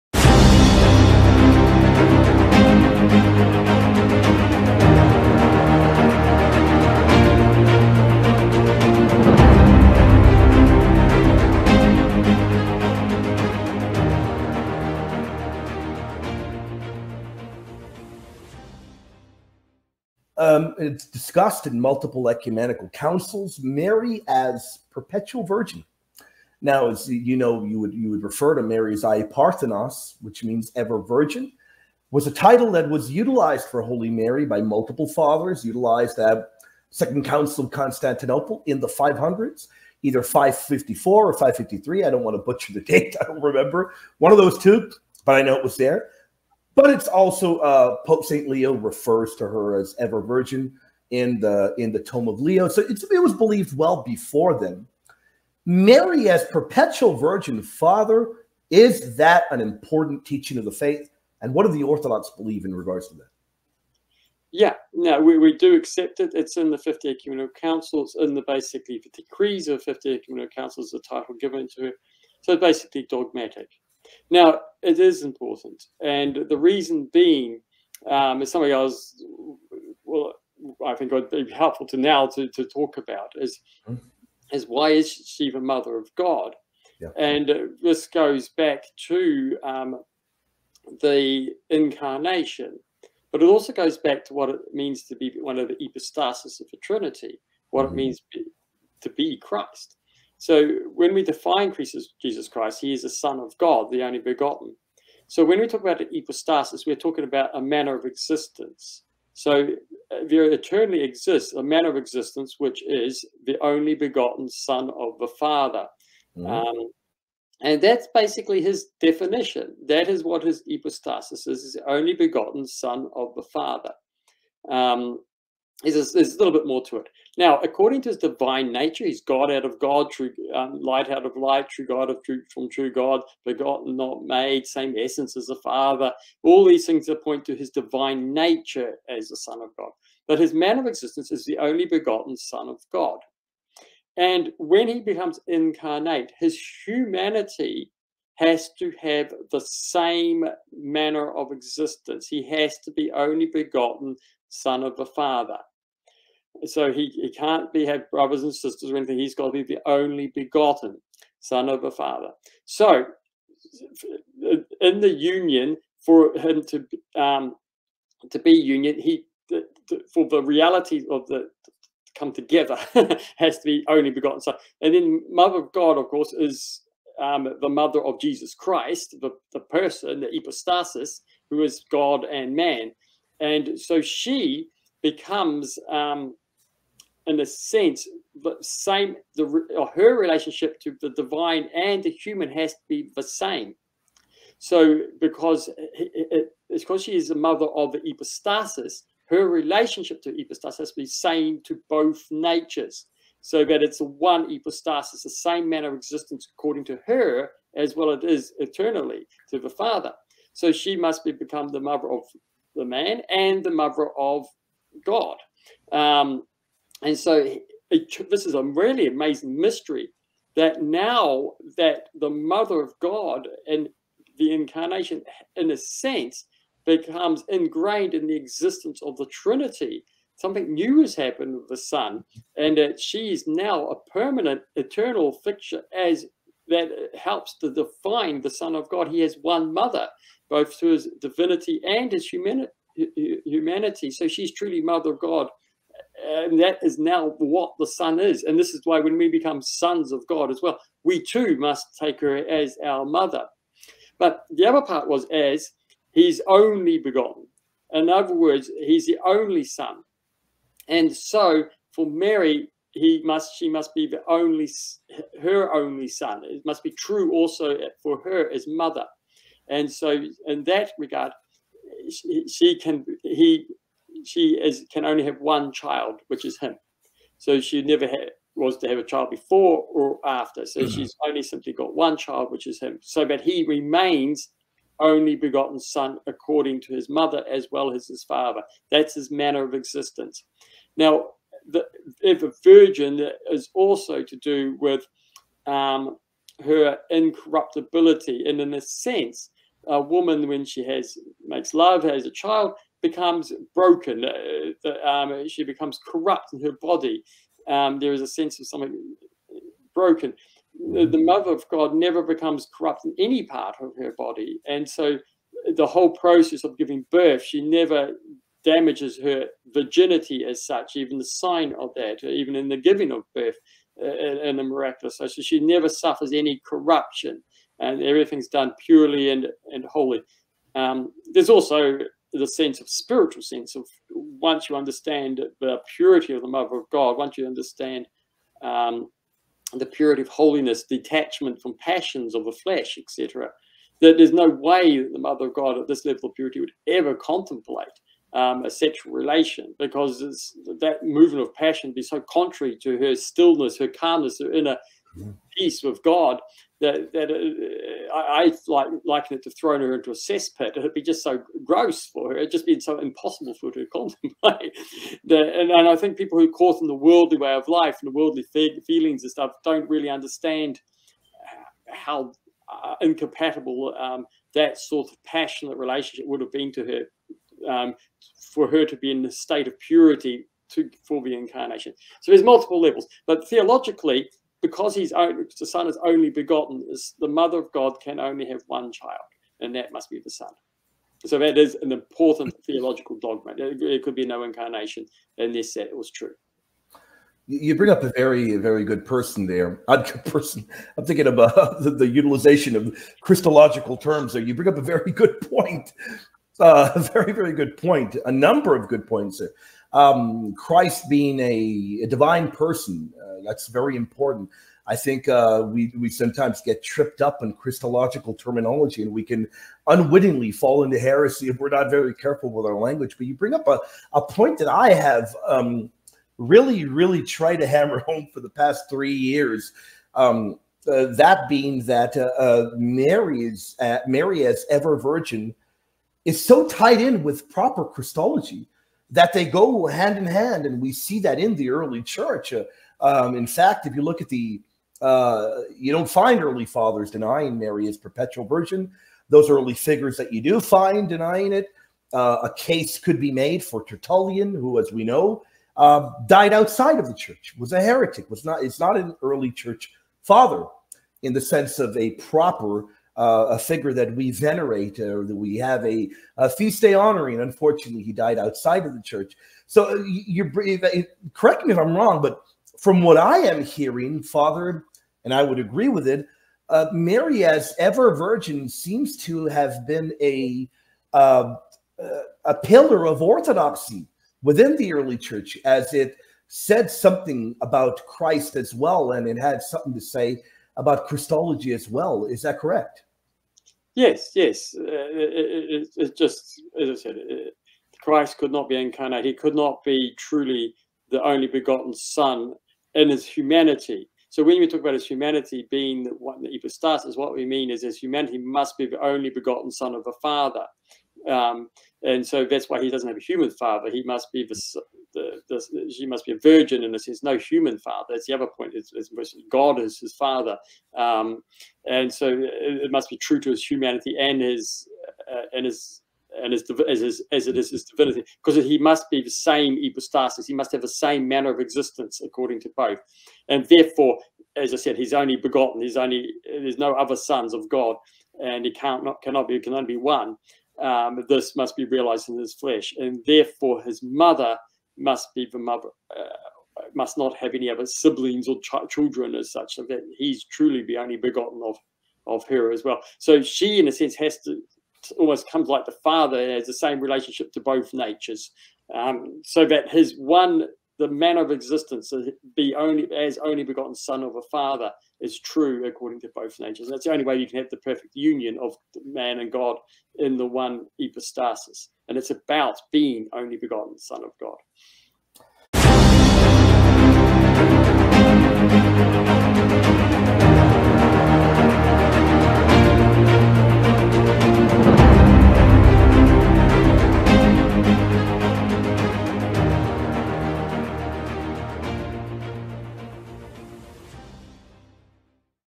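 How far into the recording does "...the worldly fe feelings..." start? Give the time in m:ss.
6:08.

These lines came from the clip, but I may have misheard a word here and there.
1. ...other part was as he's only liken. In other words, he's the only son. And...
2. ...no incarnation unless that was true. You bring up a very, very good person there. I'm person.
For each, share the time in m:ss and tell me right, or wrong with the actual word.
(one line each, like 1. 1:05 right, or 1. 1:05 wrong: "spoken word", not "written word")
1. 4:14 wrong: "begotten", not "liken"
2. 6:34 right.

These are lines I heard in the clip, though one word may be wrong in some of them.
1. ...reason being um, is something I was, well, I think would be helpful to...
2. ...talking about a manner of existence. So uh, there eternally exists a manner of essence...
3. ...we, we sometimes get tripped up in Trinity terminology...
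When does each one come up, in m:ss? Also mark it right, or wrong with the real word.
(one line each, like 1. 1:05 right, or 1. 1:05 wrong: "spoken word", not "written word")
1. 1:16 right
2. 1:46 wrong: "existence", not "essence"
3. 6:55 wrong: "Christological", not "Trinity".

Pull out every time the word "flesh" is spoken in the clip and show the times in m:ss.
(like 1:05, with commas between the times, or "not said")
5:42, 9:02.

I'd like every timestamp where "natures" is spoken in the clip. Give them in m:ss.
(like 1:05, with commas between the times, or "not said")
2:08, 2:18, 3:22, 9:17, 9:26.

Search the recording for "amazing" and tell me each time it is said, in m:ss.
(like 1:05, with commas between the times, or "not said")
3:39.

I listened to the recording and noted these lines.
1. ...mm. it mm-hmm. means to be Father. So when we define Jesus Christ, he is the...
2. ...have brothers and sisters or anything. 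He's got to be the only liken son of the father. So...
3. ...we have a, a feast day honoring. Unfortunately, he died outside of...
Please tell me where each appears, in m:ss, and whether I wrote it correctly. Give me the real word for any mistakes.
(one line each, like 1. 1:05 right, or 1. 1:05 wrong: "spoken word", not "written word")
1. 1:37 wrong: "Christ", not "Father"
2. 2:37 wrong: "begotten", not "liken"
3. 7:45 right.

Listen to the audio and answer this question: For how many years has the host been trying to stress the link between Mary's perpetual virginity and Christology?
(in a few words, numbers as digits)
3.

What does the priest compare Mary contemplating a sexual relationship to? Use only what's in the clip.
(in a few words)
throwing her into a cesspit.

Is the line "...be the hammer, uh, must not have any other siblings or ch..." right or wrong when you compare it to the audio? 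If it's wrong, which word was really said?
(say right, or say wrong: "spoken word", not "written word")
wrong: "mother", not "hammer".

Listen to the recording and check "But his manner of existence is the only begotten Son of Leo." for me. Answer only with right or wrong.
wrong.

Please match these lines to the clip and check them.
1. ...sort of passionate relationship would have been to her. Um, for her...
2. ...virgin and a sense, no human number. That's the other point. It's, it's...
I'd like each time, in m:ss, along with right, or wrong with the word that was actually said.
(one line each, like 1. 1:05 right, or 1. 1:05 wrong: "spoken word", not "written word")
1. 6:14 right
2. 8:36 wrong: "father", not "number".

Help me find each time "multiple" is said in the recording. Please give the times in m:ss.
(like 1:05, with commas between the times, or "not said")
0:21, 0:34, 6:22.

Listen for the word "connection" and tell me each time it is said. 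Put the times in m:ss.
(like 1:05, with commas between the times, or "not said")
not said.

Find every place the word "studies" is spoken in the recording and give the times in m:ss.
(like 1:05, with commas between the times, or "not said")
not said.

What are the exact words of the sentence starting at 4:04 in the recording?
So she's truly Mother of God.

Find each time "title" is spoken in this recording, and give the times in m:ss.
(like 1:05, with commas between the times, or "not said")
0:32, 1:10.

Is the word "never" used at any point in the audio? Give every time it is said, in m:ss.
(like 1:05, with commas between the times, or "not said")
4:37, 5:11, 5:17, 5:25.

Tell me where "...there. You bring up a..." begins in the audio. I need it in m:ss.
6:44.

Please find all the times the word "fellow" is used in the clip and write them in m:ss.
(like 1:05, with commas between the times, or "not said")
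not said.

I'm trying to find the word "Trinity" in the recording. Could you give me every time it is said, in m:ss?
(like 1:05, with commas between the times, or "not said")
1:36, 3:49.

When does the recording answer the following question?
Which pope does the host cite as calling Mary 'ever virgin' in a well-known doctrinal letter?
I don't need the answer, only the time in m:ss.
0:48.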